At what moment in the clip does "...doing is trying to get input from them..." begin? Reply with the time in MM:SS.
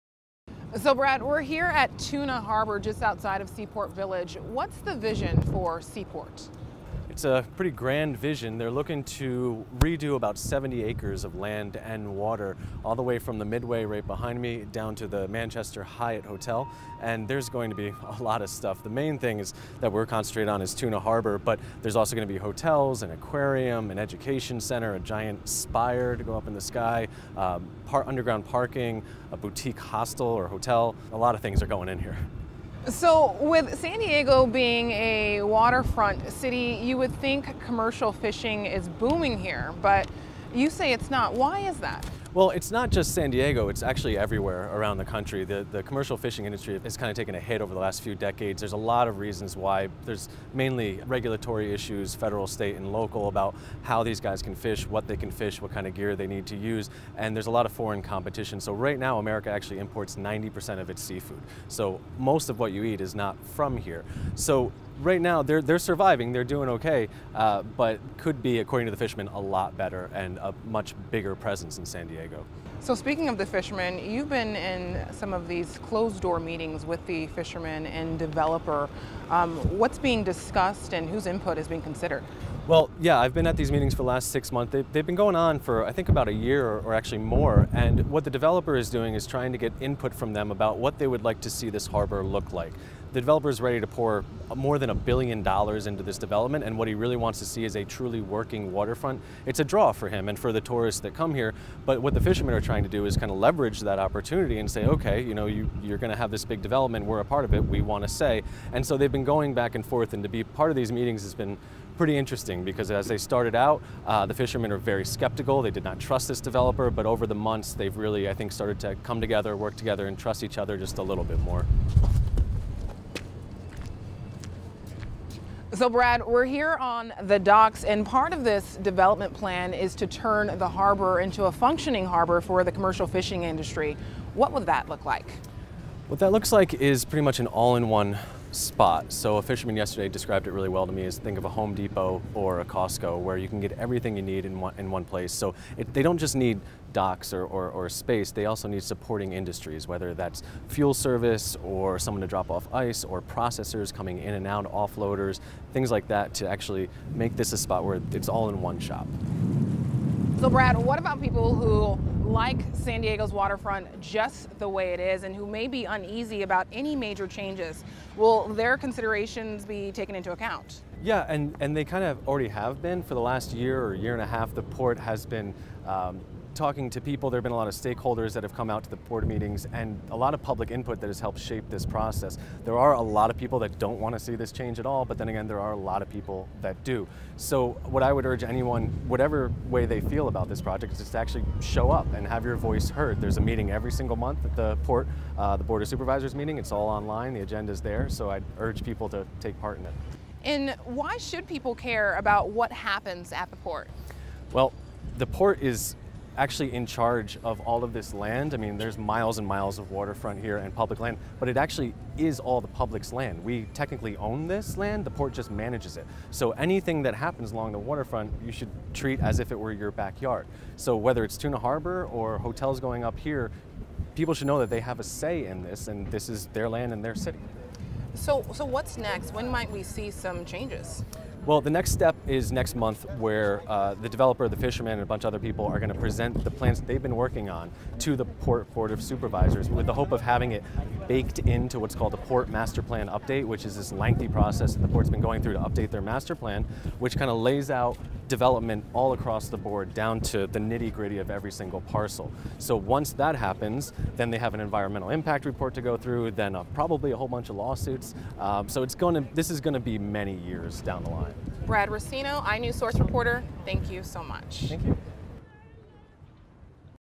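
01:28.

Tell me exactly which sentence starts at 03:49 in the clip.
When might we see some changes?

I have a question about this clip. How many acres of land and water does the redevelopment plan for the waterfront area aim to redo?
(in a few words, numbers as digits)
70.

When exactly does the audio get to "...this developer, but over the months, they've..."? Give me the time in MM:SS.
01:56.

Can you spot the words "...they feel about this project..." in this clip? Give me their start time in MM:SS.
03:09.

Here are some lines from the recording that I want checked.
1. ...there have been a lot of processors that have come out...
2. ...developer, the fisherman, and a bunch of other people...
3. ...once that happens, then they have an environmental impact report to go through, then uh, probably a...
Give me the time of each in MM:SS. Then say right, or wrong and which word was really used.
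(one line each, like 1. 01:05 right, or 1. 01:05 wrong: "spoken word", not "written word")
1. 02:57 wrong: "stakeholders", not "processors"
2. 03:54 right
3. 04:12 right.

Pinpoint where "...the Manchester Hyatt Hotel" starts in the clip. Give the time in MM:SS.
00:15.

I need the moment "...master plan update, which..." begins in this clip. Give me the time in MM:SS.
04:02.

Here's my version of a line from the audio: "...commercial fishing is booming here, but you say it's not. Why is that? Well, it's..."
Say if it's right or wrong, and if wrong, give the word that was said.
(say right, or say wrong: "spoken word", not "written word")
right.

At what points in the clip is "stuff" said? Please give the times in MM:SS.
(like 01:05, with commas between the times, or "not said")
00:18.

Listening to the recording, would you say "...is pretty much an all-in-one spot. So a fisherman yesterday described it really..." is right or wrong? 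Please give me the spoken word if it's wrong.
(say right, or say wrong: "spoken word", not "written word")
right.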